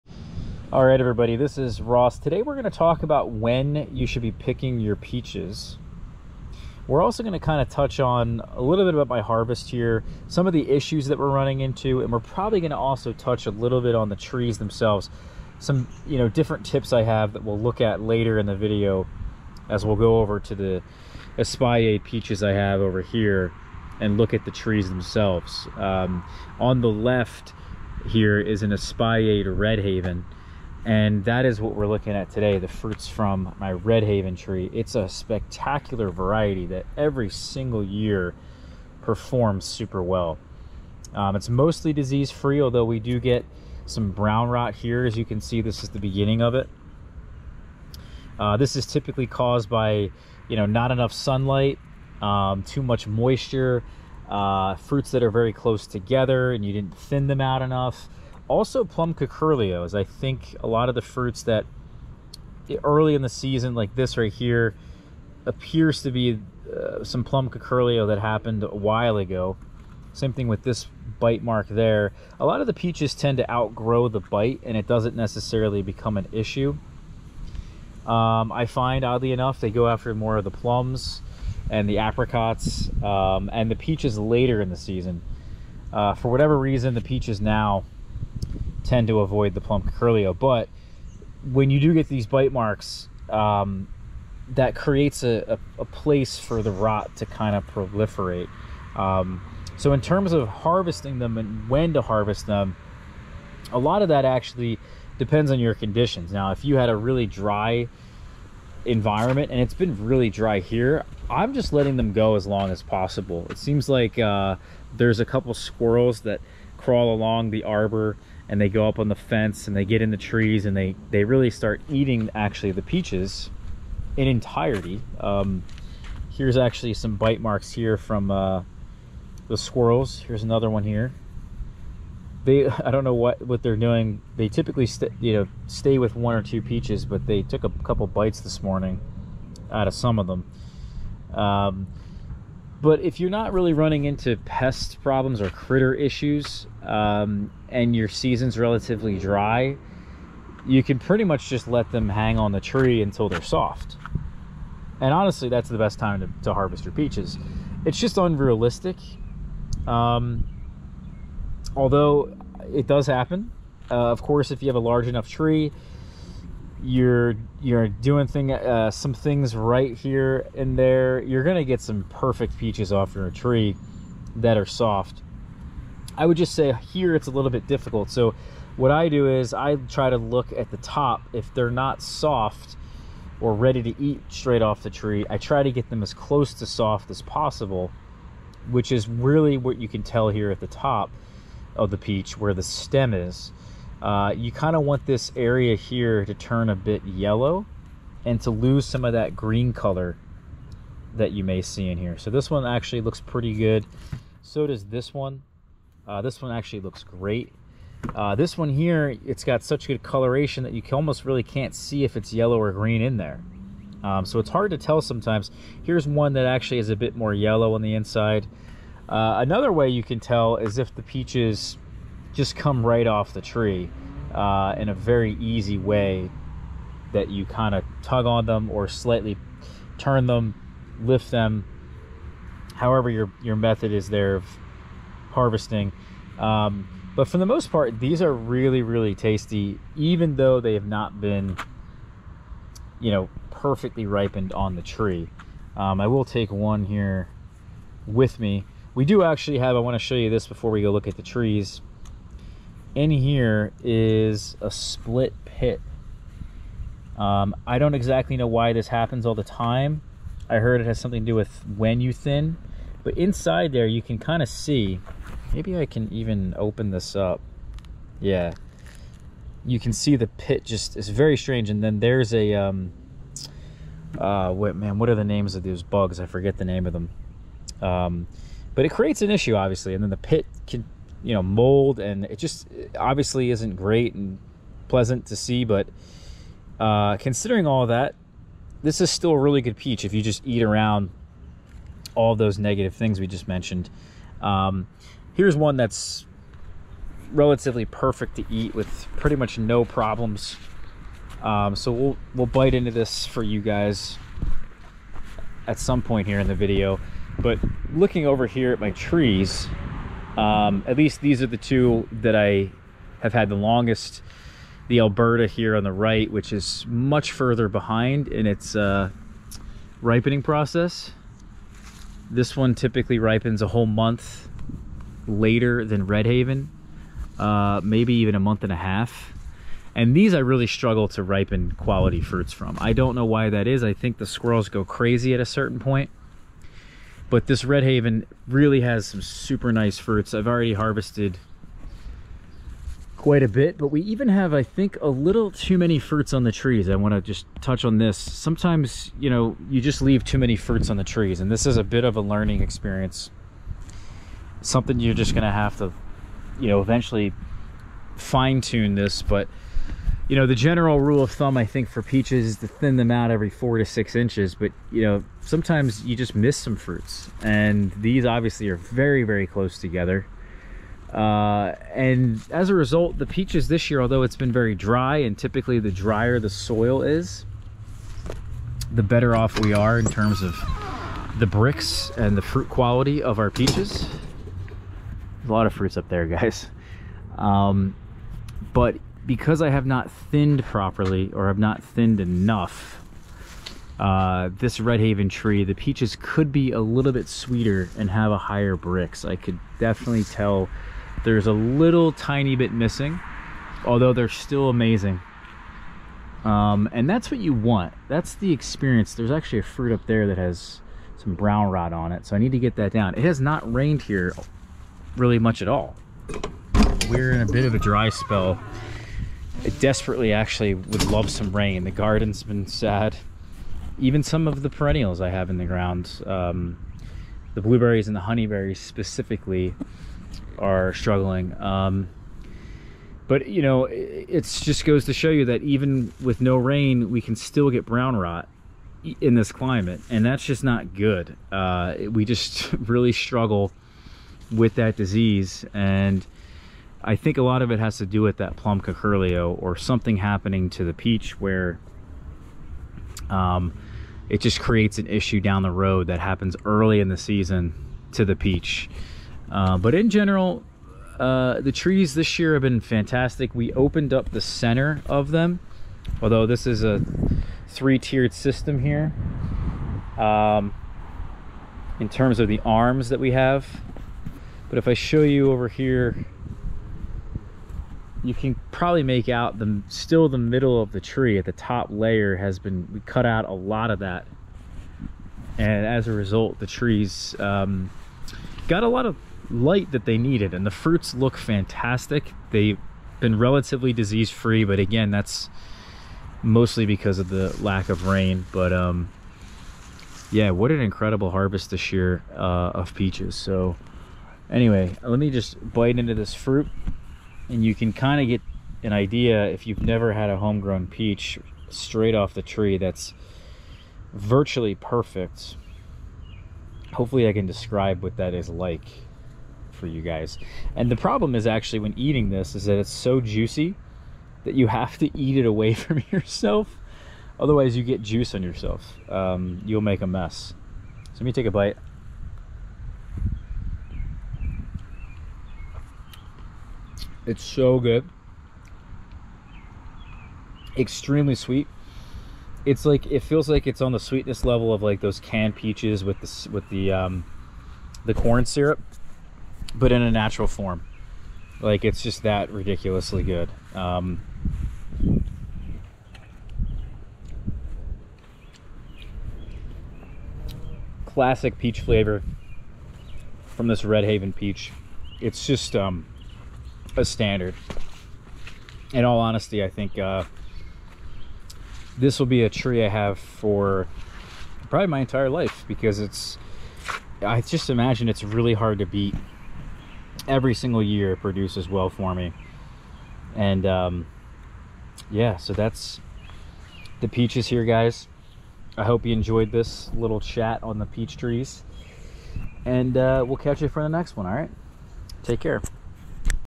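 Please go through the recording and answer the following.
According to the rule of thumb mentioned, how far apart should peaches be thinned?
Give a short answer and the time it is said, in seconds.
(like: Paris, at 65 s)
4 to 6 inches, at 363 s.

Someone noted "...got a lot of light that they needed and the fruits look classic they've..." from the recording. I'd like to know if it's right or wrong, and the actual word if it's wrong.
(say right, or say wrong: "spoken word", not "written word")
wrong: "fantastic", not "classic".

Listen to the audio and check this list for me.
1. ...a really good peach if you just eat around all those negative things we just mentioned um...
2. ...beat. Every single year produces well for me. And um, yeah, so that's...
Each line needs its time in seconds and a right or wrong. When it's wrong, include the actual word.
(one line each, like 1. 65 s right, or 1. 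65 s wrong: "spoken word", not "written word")
1. 289 s right
2. 578 s right.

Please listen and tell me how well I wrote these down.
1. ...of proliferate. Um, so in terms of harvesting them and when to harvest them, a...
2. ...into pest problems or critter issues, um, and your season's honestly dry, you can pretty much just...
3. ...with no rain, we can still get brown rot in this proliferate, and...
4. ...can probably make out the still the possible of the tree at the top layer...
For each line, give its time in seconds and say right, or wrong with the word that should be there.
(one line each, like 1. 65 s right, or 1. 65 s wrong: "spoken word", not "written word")
1. 97 s right
2. 144 s wrong: "relatively", not "honestly"
3. 436 s wrong: "climate", not "proliferate"
4. 478 s wrong: "middle", not "possible".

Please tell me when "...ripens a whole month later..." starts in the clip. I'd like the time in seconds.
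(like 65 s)
323 s.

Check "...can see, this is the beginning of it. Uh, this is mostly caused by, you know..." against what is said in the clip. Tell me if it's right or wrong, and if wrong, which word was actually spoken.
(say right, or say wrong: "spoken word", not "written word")
wrong: "typically", not "mostly".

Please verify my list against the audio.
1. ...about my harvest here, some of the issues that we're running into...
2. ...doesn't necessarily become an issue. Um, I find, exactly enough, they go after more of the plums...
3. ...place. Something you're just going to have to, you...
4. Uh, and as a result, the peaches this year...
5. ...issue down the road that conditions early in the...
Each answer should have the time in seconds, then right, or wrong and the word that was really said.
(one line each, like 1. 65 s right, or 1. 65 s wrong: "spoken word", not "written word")
1. 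8 s right
2. 74 s wrong: "oddly", not "exactly"
3. 352 s wrong: "experience", not "place"
4. 371 s right
5. 455 s wrong: "happens", not "conditions".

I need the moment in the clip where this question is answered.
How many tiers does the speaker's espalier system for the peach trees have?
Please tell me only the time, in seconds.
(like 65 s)
467 s.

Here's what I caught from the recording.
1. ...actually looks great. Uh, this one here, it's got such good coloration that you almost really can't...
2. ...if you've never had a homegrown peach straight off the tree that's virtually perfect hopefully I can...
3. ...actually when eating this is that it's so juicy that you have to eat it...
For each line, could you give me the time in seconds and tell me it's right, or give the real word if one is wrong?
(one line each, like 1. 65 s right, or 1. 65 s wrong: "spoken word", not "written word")
1. 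206 s right
2. 509 s right
3. 521 s right.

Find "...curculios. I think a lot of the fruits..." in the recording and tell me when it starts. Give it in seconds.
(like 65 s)
59 s.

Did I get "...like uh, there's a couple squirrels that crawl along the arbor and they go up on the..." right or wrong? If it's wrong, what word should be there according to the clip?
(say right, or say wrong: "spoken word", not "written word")
right.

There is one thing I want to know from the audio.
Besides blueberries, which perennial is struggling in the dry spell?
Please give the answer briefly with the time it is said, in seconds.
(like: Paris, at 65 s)
Honeyberries, at 428 s.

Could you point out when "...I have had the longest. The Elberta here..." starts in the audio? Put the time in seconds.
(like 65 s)
312 s.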